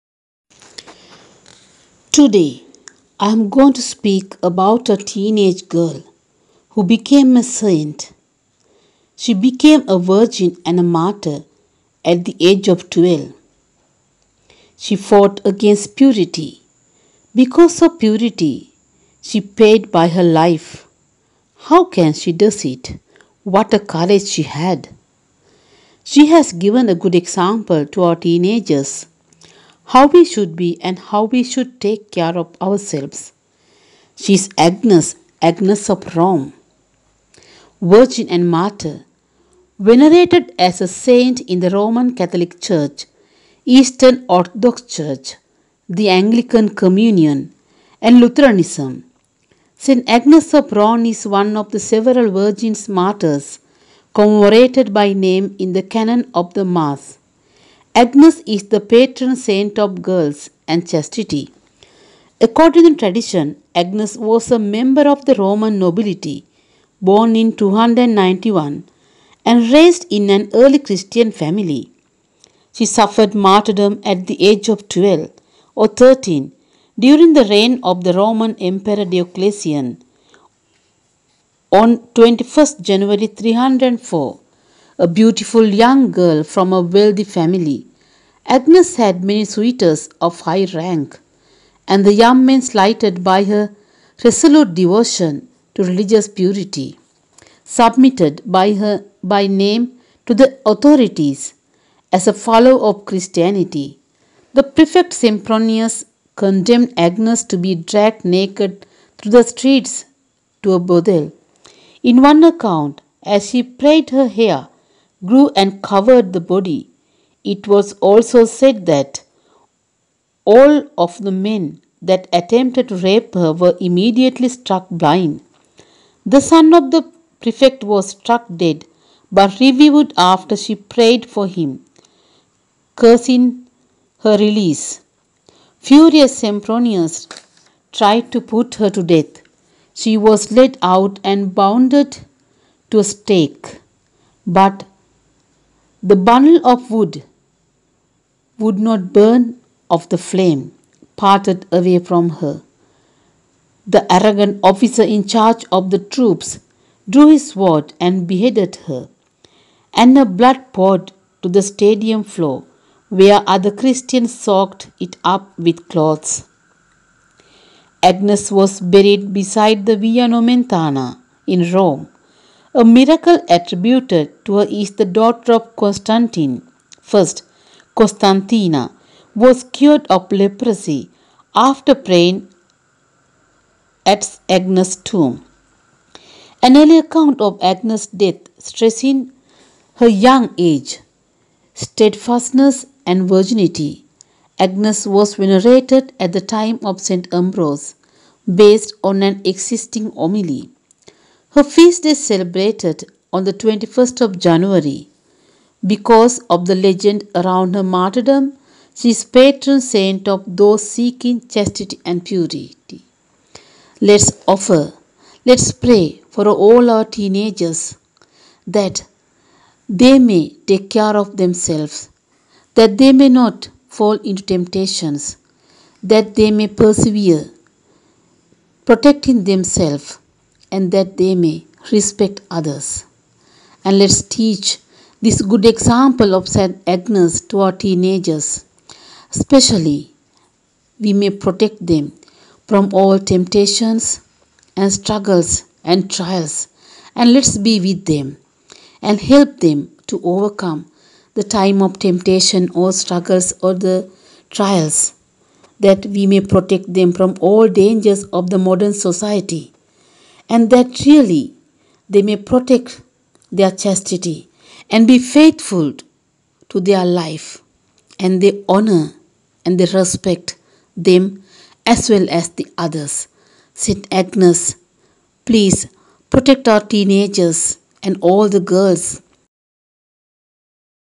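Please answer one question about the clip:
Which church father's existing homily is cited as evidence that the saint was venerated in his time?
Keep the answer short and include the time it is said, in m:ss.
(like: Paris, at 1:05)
St. Ambrose, at 3:17.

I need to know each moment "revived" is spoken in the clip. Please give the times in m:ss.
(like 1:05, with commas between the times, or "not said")
2:09.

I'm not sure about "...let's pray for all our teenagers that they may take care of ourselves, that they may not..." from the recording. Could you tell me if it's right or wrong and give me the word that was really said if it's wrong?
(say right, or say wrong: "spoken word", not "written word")
wrong: "themselves", not "ourselves".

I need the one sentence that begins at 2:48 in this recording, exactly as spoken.
Agnes was buried beside the Via Nomentana in Rome.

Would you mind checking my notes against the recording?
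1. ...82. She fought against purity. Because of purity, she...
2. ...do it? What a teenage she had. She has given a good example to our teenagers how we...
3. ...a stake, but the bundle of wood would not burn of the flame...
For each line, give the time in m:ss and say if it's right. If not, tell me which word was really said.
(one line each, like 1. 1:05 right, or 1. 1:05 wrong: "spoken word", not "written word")
1. 0:12 wrong: "12", not "82"
2. 0:22 wrong: "courage", not "teenage"
3. 2:22 right.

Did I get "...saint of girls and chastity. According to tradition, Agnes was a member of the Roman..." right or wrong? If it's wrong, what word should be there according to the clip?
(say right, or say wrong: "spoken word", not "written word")
right.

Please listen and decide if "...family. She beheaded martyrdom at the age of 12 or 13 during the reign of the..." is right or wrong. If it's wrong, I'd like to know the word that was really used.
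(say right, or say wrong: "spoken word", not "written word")
wrong: "suffered", not "beheaded".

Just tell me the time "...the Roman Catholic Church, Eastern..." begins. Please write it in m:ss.
0:41.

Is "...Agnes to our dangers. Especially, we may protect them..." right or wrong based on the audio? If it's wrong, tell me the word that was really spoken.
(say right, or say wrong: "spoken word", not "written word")
wrong: "teenagers", not "dangers".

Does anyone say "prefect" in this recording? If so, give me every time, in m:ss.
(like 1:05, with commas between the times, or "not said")
1:44, 2:07.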